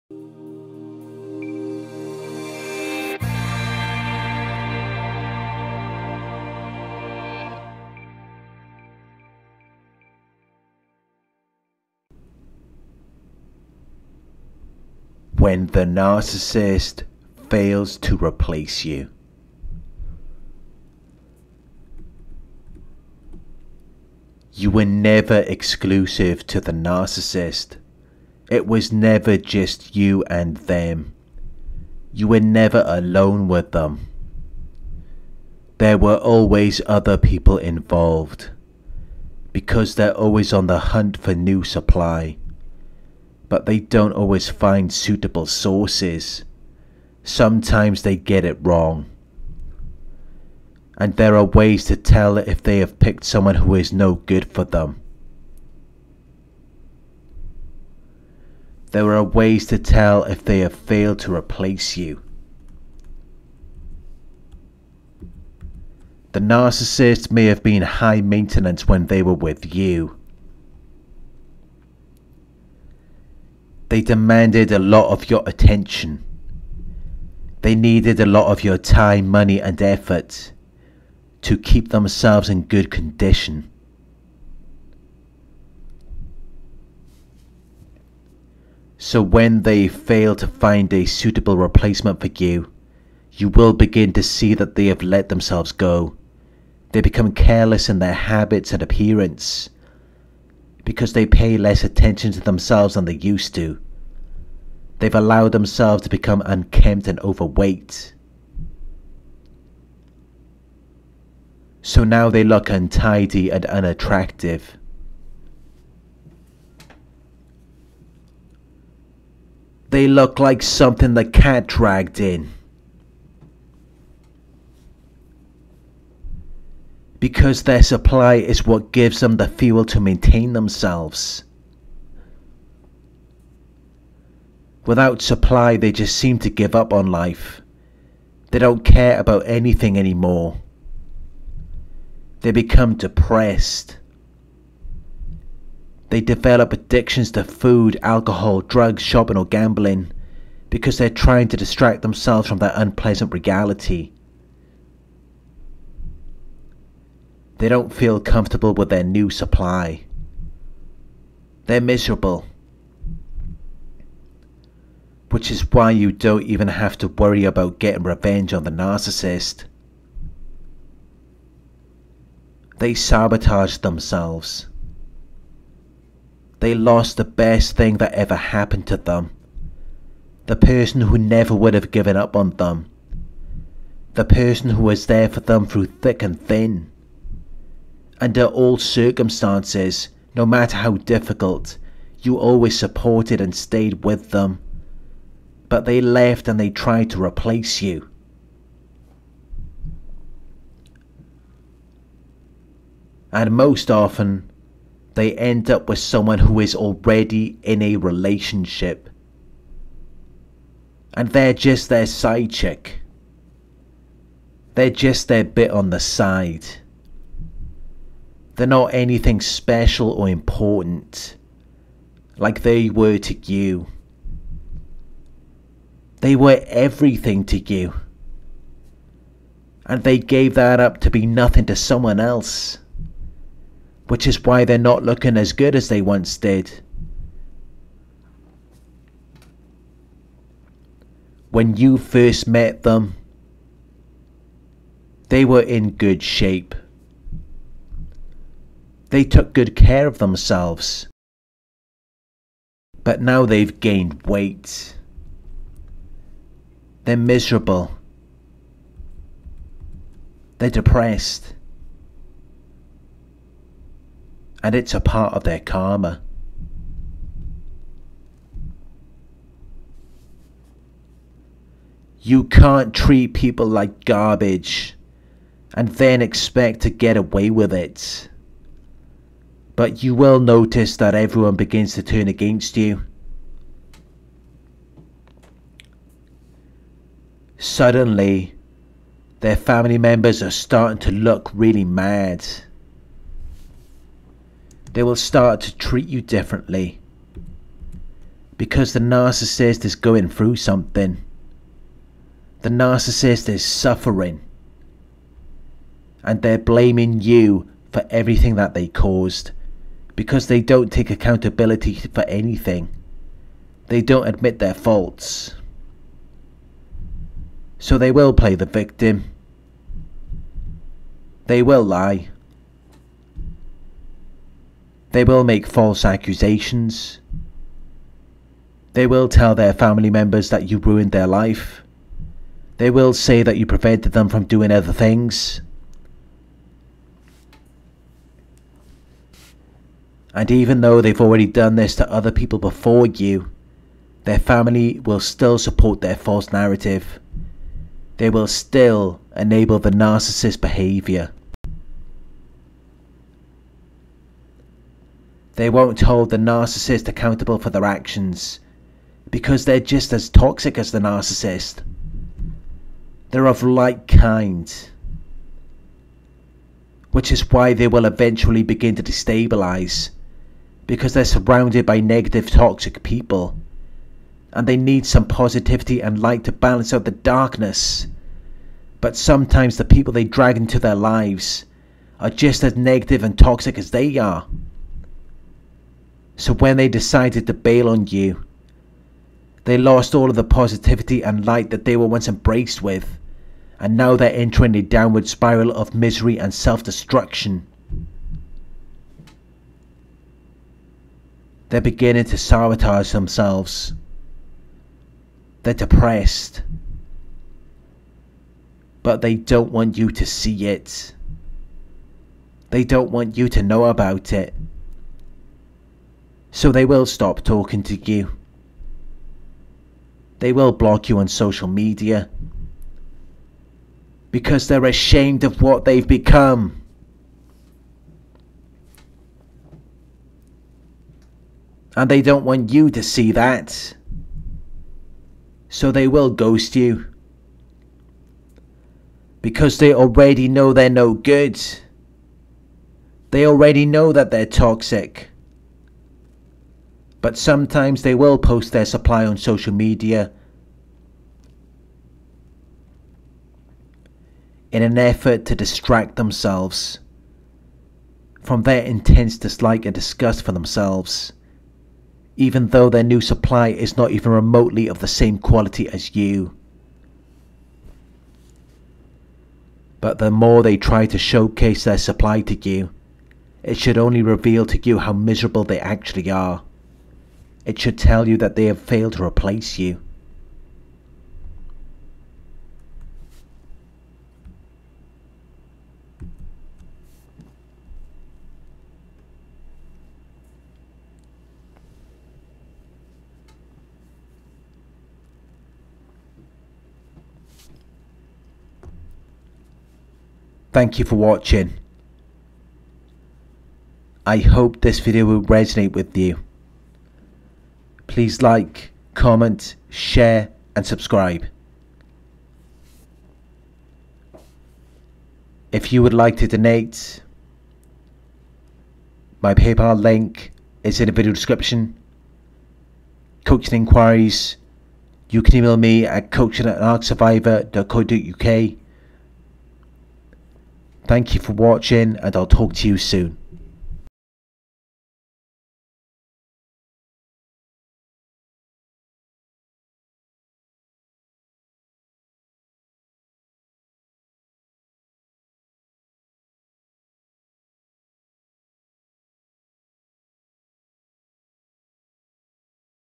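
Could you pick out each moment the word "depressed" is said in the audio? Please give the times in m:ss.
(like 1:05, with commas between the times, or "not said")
2:22, 4:20, 6:45.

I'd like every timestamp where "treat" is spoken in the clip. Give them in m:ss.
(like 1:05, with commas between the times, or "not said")
4:32, 4:55.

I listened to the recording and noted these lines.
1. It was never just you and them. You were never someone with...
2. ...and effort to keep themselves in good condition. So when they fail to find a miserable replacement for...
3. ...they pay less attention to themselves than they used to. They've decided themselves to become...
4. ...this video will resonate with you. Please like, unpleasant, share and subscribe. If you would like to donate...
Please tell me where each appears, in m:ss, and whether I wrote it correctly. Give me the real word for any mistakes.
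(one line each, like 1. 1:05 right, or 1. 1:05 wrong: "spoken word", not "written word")
1. 0:28 wrong: "alone", not "someone"
2. 1:19 wrong: "suitable", not "miserable"
3. 1:41 wrong: "allowed", not "decided"
4. 8:24 wrong: "comment", not "unpleasant".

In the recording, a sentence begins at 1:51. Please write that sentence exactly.
So now they look untidy and unattractive.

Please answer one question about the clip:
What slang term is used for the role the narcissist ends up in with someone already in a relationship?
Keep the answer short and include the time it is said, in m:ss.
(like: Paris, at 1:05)
side chick, at 3:32.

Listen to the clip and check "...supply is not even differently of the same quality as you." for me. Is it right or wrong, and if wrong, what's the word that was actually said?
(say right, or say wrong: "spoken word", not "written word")
wrong: "remotely", not "differently".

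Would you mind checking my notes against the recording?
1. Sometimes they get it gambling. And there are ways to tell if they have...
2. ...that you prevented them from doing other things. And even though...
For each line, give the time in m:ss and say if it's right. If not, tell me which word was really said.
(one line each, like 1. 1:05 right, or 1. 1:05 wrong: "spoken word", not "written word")
1. 0:47 wrong: "wrong", not "gambling"
2. 5:33 right.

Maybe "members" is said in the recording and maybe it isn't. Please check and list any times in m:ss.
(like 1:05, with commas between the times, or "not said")
4:49, 5:30.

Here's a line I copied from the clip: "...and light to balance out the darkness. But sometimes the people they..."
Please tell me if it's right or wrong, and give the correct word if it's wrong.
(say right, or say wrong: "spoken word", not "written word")
right.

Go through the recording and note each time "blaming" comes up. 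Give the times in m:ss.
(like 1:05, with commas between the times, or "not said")
5:06.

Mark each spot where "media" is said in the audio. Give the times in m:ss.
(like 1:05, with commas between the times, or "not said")
7:01, 7:29.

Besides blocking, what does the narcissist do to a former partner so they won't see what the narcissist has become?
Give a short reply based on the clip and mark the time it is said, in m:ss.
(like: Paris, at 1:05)
ghost you, at 7:16.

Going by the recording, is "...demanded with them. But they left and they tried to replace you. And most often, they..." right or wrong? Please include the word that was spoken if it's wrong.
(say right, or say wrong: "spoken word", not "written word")
wrong: "stayed", not "demanded".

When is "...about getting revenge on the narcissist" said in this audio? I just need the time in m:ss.
2:47.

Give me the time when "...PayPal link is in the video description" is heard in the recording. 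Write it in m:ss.
8:39.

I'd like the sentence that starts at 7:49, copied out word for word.
But the more they try to showcase their supply to you, it should only reveal to you how miserable they actually are.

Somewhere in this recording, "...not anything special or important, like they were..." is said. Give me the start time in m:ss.
3:38.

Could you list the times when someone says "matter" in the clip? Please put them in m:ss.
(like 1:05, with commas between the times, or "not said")
3:10.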